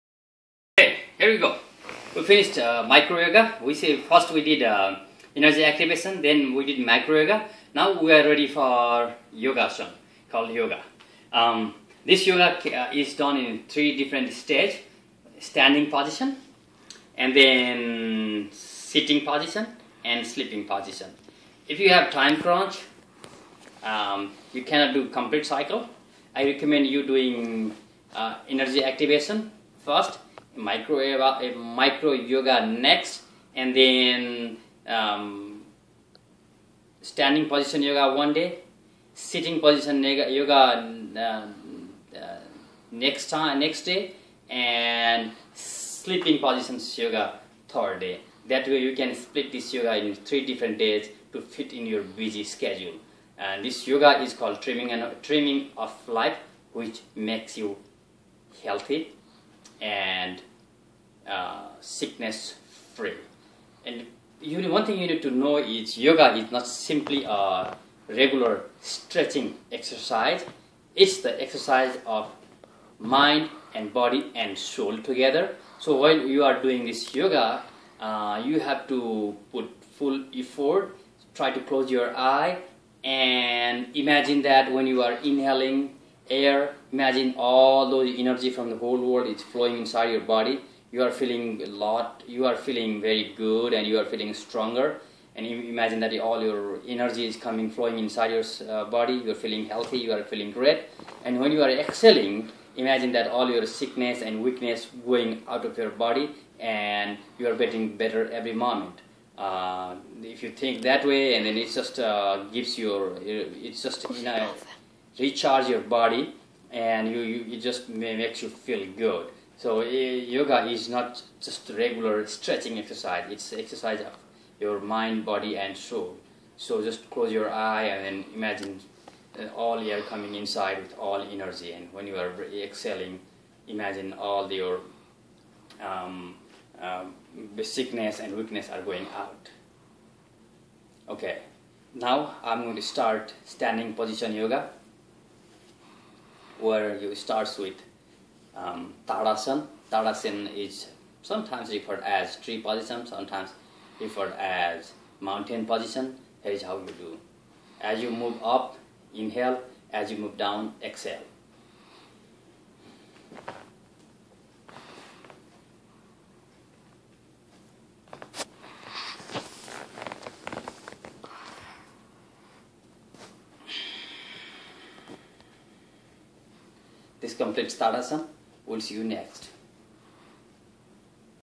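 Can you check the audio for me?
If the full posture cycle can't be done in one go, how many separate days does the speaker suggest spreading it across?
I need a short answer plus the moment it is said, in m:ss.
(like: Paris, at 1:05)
3, at 0:50.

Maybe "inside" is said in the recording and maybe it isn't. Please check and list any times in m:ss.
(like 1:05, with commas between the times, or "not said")
1:29, 1:37, 2:10.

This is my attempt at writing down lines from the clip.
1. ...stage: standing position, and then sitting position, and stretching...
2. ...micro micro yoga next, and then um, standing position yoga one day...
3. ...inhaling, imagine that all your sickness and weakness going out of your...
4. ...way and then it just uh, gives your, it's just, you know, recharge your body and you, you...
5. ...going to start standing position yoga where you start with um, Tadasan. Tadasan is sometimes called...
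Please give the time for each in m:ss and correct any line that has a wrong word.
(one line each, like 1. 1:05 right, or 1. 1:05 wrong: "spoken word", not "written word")
1. 0:14 wrong: "sleeping", not "stretching"
2. 0:30 right
3. 1:41 wrong: "exhaling", not "inhaling"
4. 1:51 right
5. 2:22 wrong: "referred", not "called".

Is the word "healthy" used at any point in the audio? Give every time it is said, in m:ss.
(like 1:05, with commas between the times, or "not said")
0:58, 1:39.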